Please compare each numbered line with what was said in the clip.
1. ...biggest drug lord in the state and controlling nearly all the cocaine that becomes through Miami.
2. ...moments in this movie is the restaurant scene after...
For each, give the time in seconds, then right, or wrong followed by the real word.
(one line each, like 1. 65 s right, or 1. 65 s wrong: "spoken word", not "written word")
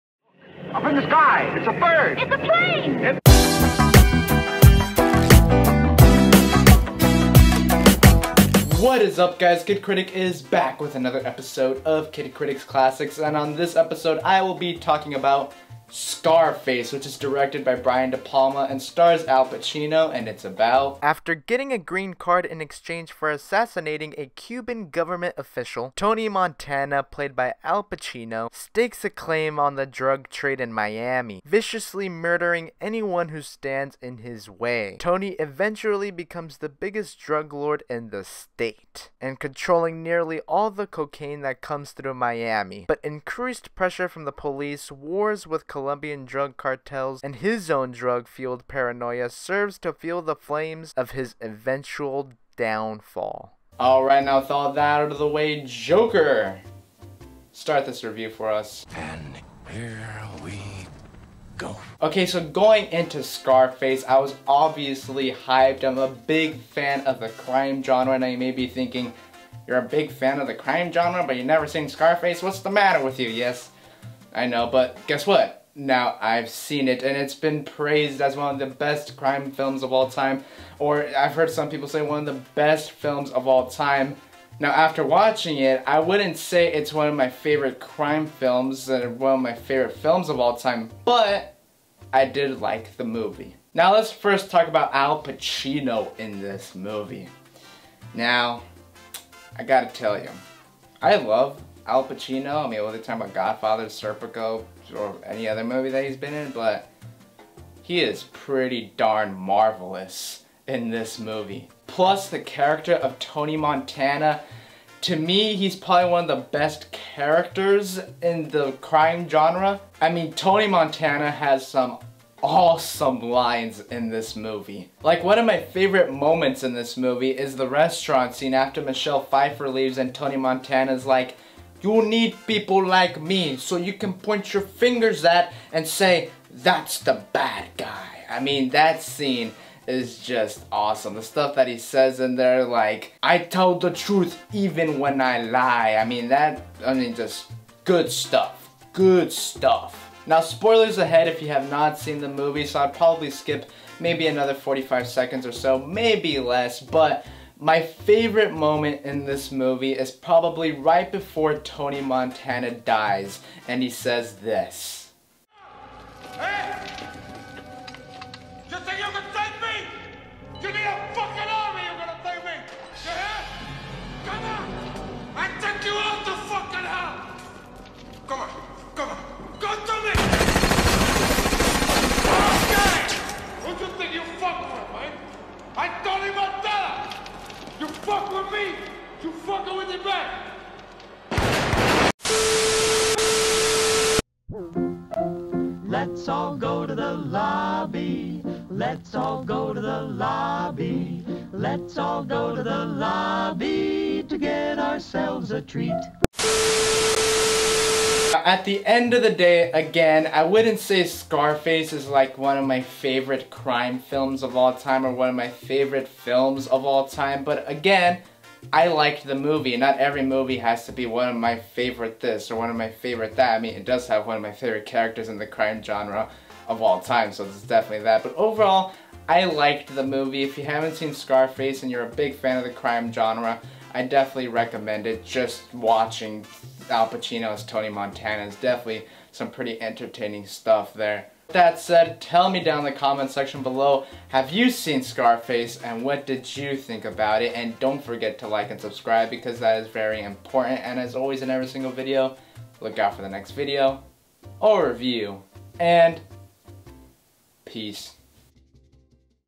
1. 36 s wrong: "comes", not "becomes"
2. 126 s right.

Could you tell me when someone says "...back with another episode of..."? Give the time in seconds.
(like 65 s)
10 s.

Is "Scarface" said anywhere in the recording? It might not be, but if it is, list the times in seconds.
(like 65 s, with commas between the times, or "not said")
15 s, 63 s, 71 s, 211 s, 231 s, 245 s.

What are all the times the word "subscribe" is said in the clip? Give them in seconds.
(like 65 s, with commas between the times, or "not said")
248 s.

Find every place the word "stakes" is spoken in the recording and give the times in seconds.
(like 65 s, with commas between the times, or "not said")
28 s.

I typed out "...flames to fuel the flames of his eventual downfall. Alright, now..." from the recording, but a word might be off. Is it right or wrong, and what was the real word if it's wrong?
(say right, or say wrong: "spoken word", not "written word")
wrong: "serves", not "flames".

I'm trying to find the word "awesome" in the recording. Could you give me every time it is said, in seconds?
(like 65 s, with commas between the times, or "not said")
122 s, 140 s.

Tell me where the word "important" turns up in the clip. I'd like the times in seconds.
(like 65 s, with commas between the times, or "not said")
250 s.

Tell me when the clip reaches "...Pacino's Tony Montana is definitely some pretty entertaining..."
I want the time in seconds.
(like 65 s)
237 s.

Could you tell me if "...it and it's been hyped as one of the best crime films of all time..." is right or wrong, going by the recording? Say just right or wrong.
wrong.